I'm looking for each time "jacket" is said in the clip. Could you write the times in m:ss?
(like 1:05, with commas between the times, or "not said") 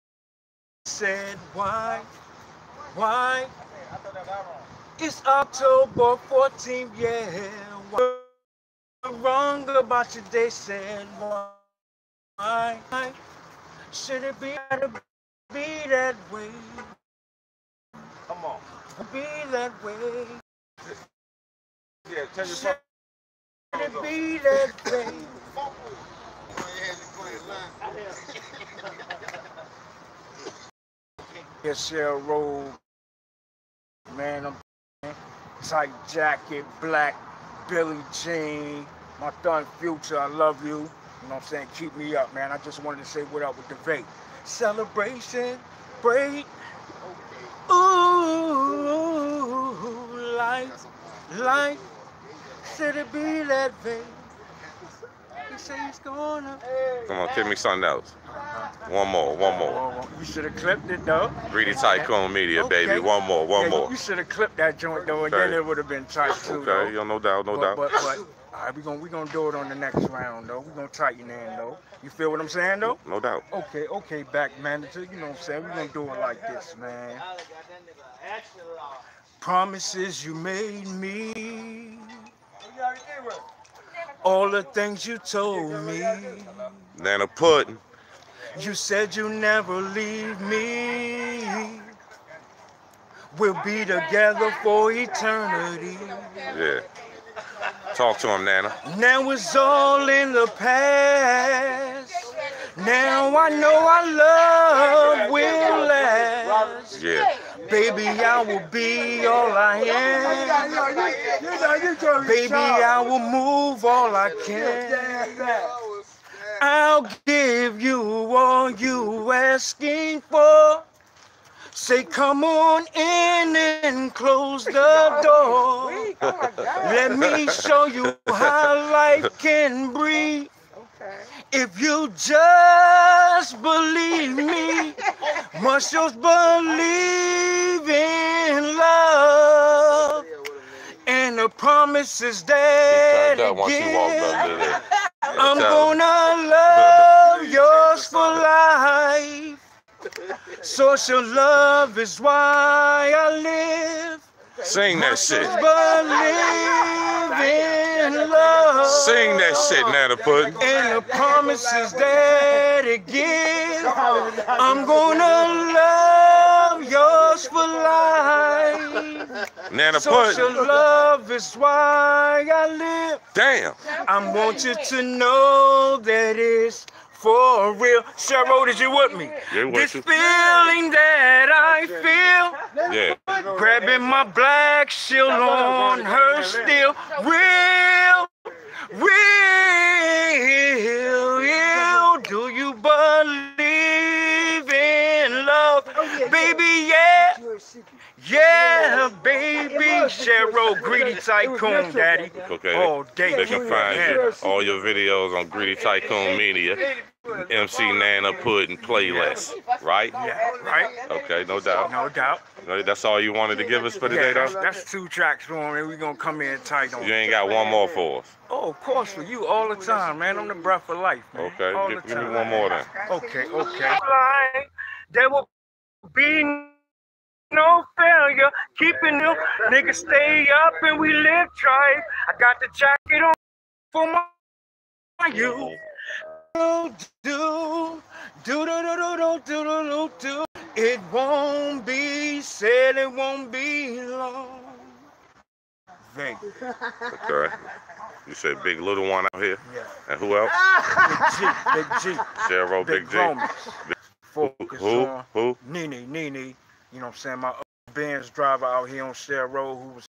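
0:36, 3:52.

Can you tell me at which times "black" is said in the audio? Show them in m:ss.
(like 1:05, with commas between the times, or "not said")
0:36, 3:04.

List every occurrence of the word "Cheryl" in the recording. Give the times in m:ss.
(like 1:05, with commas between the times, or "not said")
2:58, 3:20.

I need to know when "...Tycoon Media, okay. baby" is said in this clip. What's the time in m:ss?
1:01.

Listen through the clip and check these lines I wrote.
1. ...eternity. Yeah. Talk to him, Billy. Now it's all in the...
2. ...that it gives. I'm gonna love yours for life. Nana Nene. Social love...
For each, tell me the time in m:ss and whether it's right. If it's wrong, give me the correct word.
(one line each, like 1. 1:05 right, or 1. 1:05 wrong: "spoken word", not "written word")
1. 1:34 wrong: "Nana", not "Billy"
2. 2:41 wrong: "Punch", not "Nene".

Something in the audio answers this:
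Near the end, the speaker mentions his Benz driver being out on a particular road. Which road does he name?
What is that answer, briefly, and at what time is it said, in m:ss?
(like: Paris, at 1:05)
Share Road, at 4:19.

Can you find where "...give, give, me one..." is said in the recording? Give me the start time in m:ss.
3:41.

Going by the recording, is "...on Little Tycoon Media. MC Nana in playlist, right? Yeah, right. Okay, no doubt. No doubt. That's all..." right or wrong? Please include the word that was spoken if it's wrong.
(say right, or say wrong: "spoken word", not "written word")
wrong: "Greedy", not "Little".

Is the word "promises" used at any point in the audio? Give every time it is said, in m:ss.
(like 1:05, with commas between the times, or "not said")
1:19, 2:21, 2:41.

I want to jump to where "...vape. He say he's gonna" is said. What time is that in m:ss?
0:53.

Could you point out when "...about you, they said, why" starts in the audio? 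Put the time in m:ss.
0:09.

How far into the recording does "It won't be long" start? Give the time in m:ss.
4:02.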